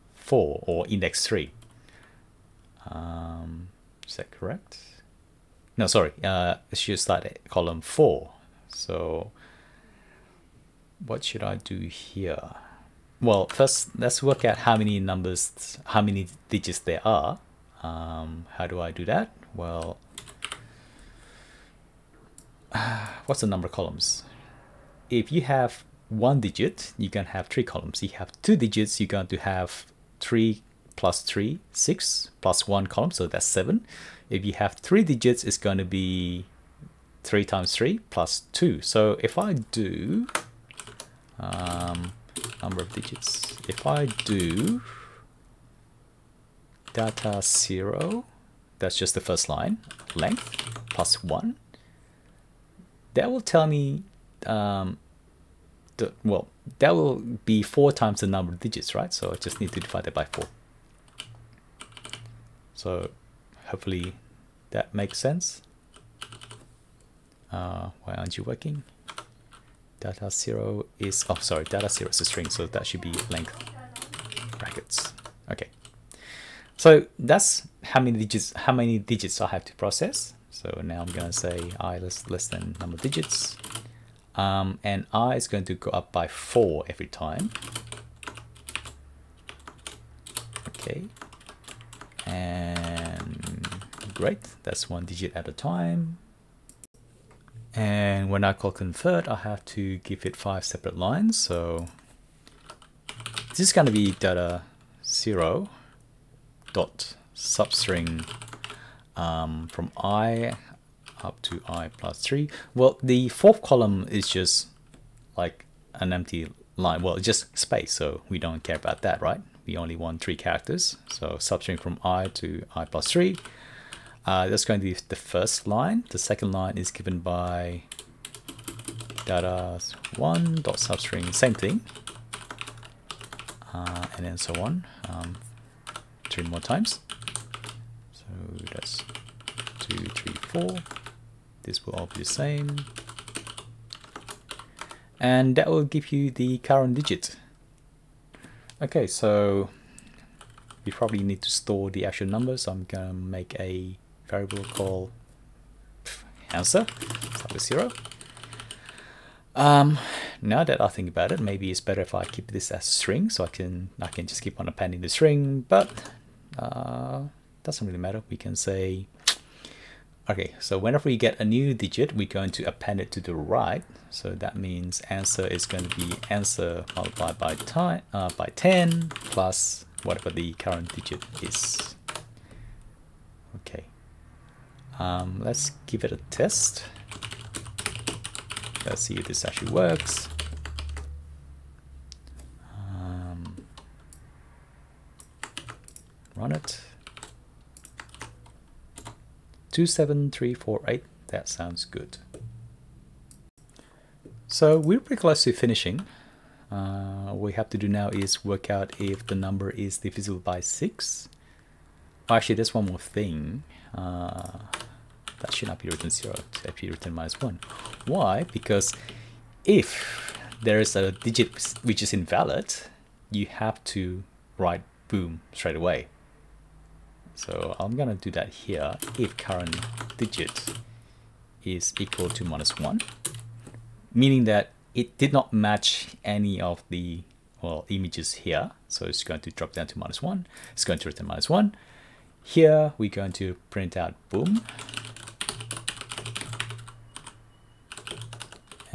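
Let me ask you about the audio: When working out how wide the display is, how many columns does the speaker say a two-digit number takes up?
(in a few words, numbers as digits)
7.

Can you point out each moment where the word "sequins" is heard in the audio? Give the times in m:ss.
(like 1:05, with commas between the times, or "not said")
not said.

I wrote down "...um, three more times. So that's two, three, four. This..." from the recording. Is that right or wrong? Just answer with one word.
right.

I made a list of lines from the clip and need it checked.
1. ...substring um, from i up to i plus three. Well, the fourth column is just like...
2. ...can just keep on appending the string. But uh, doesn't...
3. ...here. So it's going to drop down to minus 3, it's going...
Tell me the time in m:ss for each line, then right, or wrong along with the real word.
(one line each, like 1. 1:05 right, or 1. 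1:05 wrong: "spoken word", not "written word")
1. 1:47 right
2. 2:44 right
3. 3:58 wrong: "1", not "3".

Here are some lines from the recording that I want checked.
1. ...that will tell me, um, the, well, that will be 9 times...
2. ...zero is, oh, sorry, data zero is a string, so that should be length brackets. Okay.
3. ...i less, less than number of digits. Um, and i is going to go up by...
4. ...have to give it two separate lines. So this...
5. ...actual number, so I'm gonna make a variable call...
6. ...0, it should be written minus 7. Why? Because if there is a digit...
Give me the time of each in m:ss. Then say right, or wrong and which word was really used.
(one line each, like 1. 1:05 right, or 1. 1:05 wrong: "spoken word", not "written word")
1. 0:53 wrong: "4", not "9"
2. 1:10 right
3. 1:21 right
4. 1:39 wrong: "five", not "two"
5. 2:32 right
6. 3:36 wrong: "1", not "7".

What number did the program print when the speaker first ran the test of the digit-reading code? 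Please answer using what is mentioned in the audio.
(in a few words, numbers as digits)
27348.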